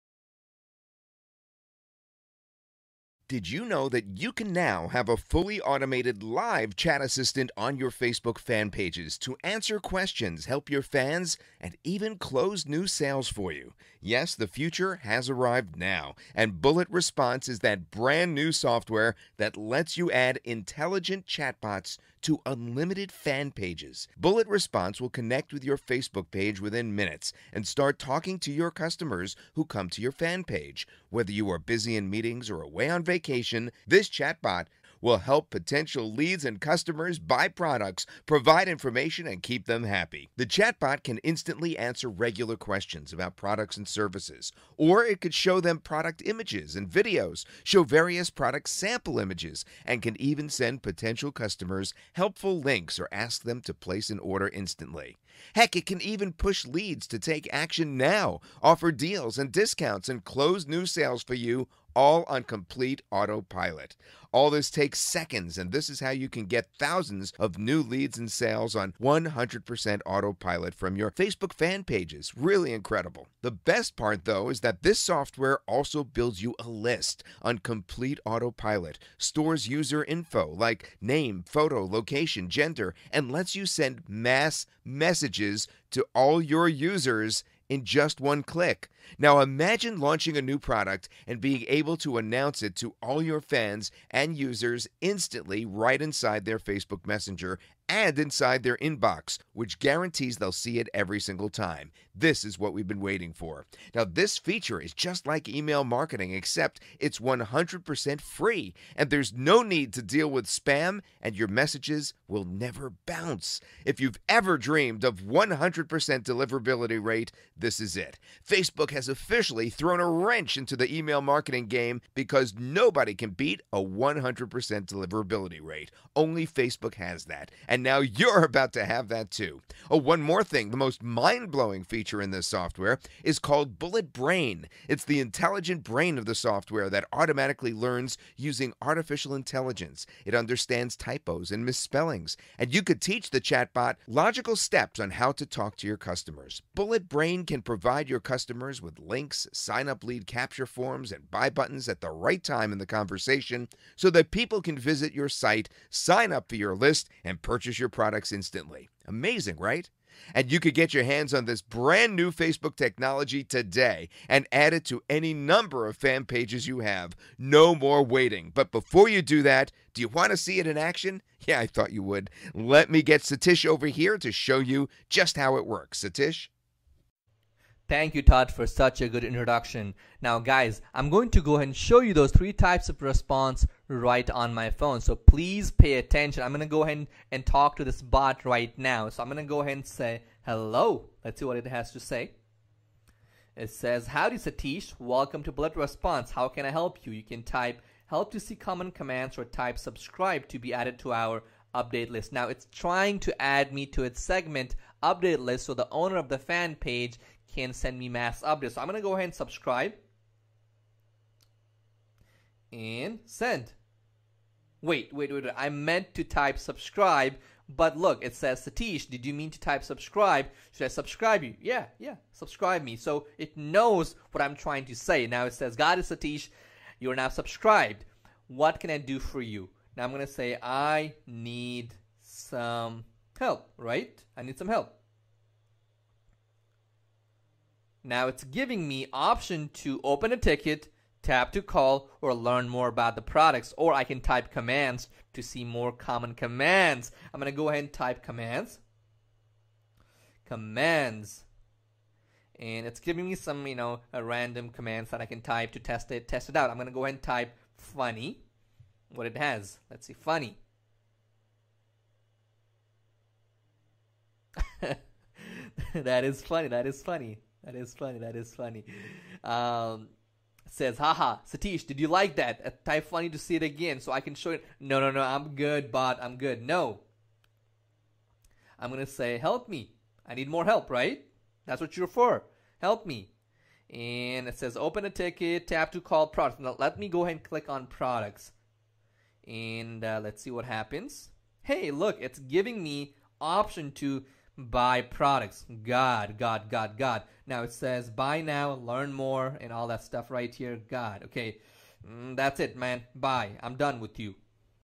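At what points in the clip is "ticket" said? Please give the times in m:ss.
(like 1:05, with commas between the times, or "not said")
4:00, 4:45.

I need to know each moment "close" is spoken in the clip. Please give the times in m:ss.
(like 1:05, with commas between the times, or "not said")
0:12, 1:00.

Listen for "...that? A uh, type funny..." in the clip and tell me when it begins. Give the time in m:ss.
4:32.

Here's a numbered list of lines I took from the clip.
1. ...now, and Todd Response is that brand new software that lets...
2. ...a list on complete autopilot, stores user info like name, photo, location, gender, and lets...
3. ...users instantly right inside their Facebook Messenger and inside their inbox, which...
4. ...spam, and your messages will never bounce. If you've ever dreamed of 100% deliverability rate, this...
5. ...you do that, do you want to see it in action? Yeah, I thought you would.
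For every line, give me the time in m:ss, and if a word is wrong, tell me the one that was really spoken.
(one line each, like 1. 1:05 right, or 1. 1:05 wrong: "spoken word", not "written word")
1. 0:15 wrong: "Bullet", not "Todd"
2. 1:16 right
3. 1:34 right
4. 1:50 right
5. 2:49 right.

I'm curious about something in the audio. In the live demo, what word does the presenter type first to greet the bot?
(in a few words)
hello.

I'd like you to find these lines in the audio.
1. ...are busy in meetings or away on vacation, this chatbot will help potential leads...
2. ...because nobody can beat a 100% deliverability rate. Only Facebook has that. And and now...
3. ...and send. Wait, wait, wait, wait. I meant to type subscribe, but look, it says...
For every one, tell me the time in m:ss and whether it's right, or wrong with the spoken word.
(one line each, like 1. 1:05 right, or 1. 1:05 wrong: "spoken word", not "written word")
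1. 0:31 right
2. 2:02 right
3. 3:32 right.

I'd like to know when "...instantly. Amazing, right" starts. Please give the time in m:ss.
2:38.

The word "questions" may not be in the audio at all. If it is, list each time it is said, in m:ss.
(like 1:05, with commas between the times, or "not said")
0:09, 0:42.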